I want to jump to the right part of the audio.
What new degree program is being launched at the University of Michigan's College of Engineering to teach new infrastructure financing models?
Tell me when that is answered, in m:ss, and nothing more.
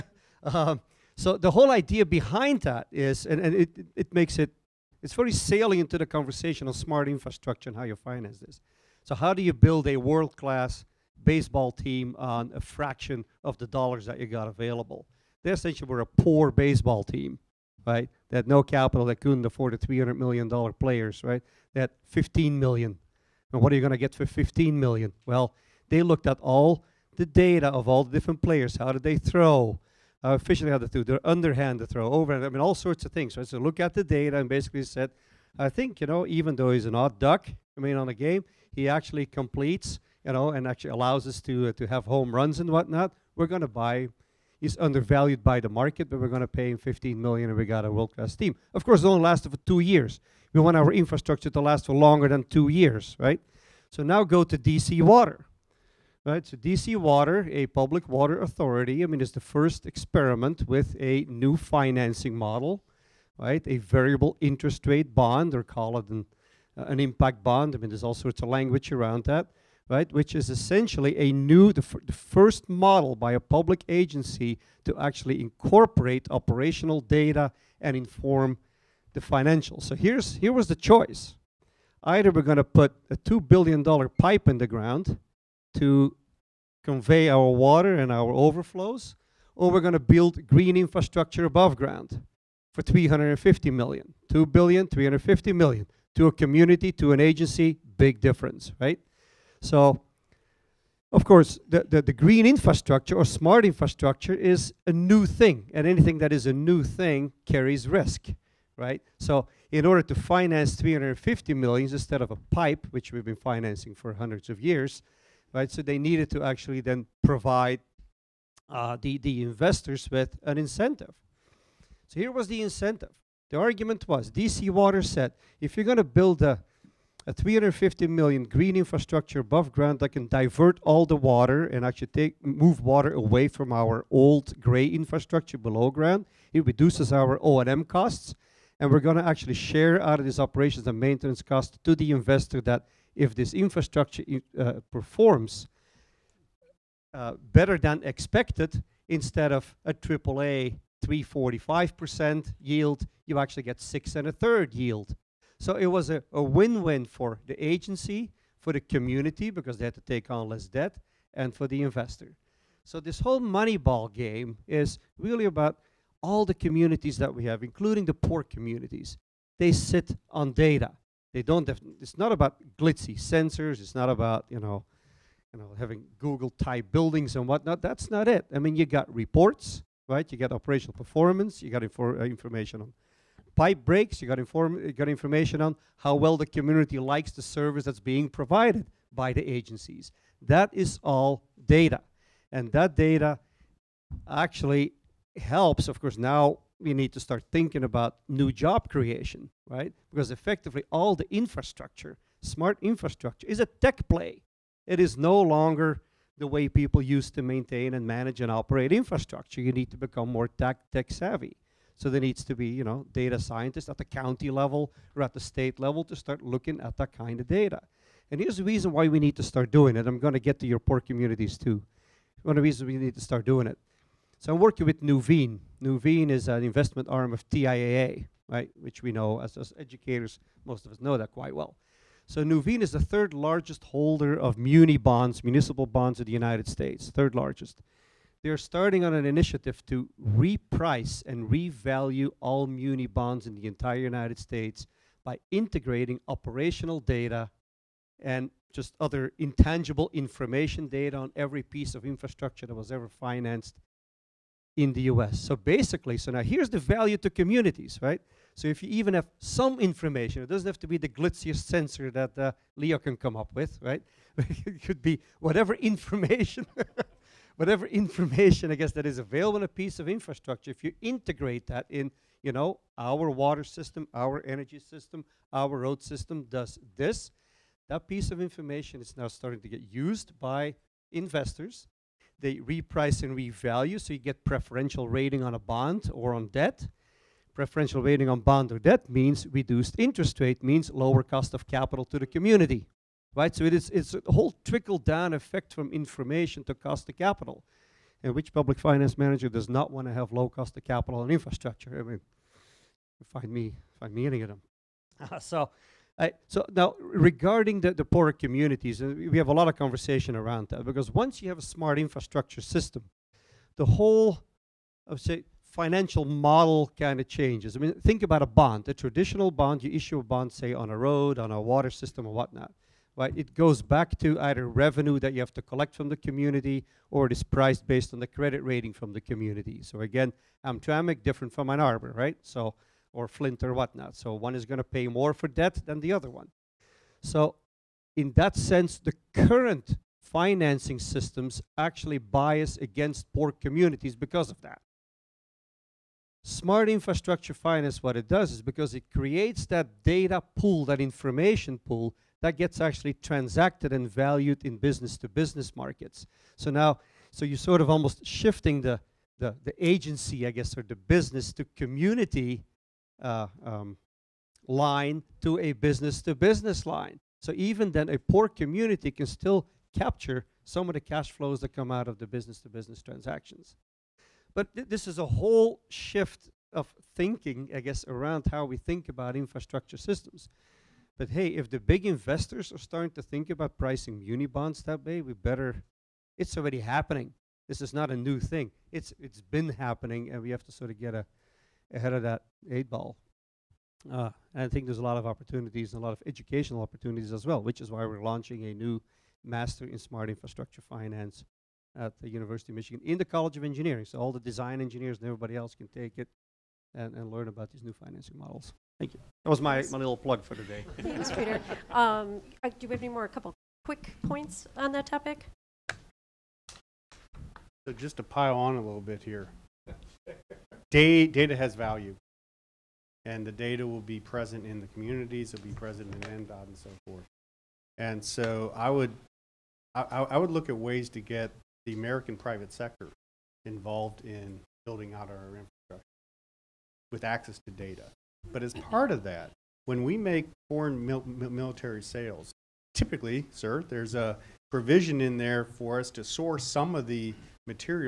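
6:39.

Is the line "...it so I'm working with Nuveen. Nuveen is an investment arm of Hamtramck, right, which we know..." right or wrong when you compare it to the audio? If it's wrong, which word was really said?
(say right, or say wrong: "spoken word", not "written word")
wrong: "TIAA", not "Hamtramck".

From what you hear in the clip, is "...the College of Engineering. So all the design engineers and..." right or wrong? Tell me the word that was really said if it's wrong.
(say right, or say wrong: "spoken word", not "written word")
right.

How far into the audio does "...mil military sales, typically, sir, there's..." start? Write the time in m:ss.
7:21.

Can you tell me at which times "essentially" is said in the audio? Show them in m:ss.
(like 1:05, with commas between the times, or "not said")
0:15, 1:10.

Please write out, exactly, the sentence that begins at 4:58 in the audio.
And which public finance manager does not want to have low cost of capital and infrastructure?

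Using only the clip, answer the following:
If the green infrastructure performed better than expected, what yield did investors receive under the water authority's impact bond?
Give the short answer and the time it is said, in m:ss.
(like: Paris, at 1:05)
six and a third, at 2:33.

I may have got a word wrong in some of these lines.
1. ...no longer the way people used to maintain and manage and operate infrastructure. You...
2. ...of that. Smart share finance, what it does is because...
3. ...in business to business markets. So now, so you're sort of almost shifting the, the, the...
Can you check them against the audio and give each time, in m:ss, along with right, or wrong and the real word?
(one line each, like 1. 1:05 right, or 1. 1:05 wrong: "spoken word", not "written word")
1. 3:25 right
2. 5:44 wrong: "infrastructure", not "share"
3. 5:54 right.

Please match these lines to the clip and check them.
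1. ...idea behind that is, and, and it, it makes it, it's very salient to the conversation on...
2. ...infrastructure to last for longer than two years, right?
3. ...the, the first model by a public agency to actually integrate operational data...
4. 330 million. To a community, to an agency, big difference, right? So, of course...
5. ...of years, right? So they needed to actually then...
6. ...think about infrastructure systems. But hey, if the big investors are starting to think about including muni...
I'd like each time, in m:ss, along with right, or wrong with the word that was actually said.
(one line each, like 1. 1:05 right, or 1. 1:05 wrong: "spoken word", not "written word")
1. 0:01 right
2. 0:50 right
3. 1:11 wrong: "incorporate", not "integrate"
4. 1:34 wrong: "350", not "330"
5. 1:54 right
6. 6:18 wrong: "pricing", not "including".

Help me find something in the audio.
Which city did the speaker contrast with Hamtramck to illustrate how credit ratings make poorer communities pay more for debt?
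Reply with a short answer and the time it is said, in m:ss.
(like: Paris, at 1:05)
Ann Arbor, at 5:31.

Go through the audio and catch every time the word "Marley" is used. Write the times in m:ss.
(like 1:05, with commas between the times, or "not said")
not said.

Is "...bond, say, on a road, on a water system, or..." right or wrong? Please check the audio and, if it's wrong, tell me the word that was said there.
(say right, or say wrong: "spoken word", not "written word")
right.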